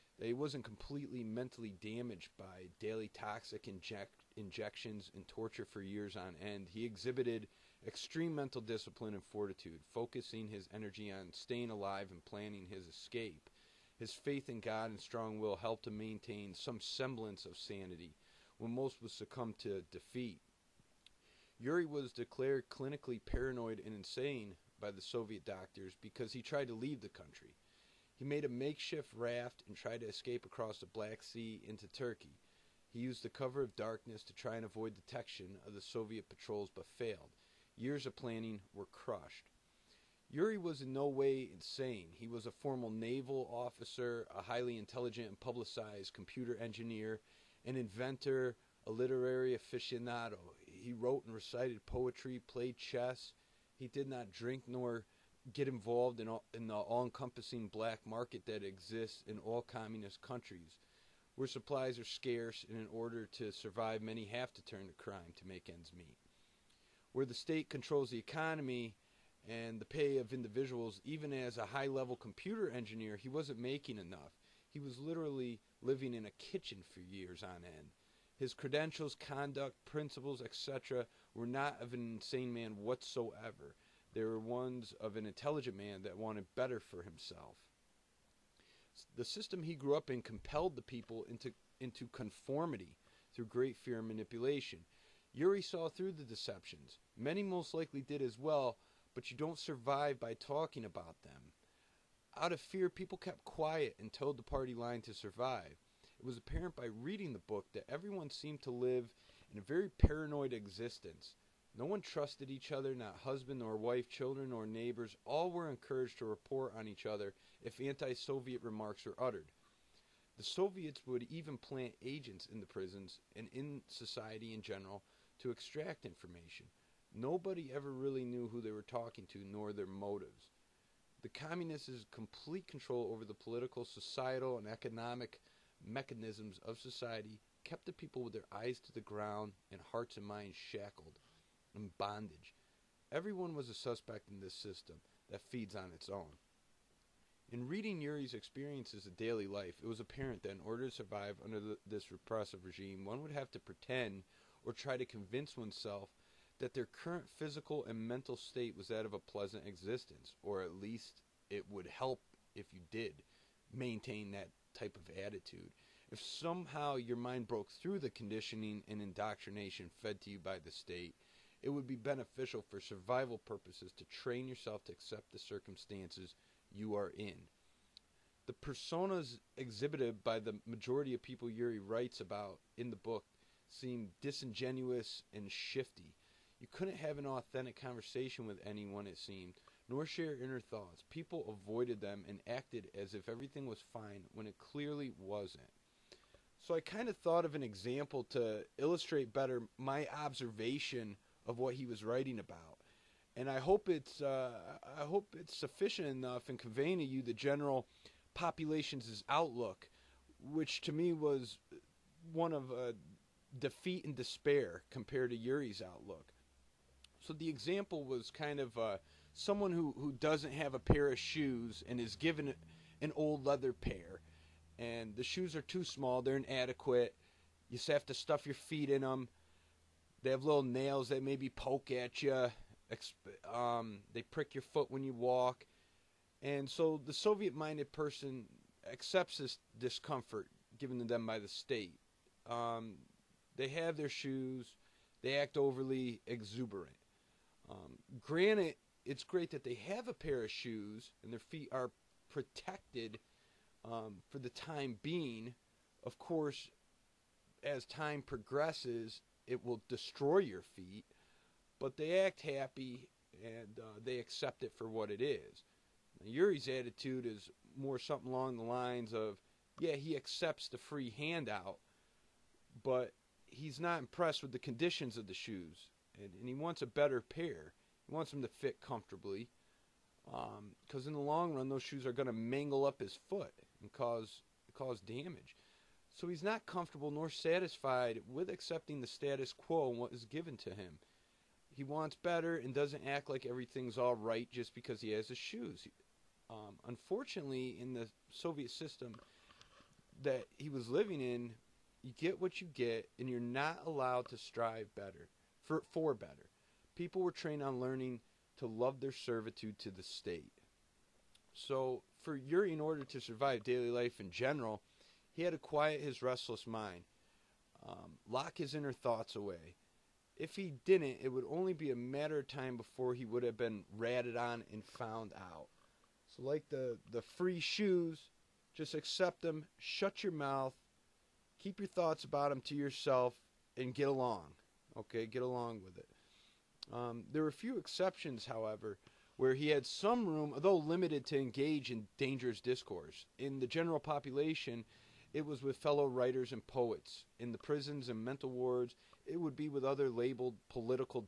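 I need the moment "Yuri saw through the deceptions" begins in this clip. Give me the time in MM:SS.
01:35.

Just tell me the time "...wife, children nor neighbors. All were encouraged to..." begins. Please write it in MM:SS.
01:53.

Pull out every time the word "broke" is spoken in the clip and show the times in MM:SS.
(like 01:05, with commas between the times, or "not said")
02:47.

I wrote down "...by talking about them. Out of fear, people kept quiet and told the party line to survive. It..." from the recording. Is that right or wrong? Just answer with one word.
right.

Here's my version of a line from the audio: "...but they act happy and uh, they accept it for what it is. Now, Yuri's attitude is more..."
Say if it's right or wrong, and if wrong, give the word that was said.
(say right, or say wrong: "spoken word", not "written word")
right.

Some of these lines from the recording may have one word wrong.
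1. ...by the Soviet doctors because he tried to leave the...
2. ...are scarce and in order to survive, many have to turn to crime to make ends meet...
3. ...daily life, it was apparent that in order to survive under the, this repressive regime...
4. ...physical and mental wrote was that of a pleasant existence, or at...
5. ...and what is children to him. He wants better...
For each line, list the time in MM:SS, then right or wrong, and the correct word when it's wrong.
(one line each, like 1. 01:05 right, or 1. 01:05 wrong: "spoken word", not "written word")
1. 00:24 right
2. 01:01 right
3. 02:29 right
4. 02:37 wrong: "state", not "wrote"
5. 04:49 wrong: "given", not "children".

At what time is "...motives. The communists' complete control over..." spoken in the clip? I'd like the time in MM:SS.
02:09.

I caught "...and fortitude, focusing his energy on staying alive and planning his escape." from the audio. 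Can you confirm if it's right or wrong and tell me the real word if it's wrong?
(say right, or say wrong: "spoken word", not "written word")
right.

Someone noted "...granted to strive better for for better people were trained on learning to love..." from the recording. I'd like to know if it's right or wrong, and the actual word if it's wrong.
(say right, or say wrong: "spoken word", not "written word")
wrong: "allowed", not "granted".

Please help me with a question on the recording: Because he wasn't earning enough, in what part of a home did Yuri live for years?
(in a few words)
A kitchen.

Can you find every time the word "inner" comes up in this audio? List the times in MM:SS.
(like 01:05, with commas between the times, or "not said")
03:10, 05:18.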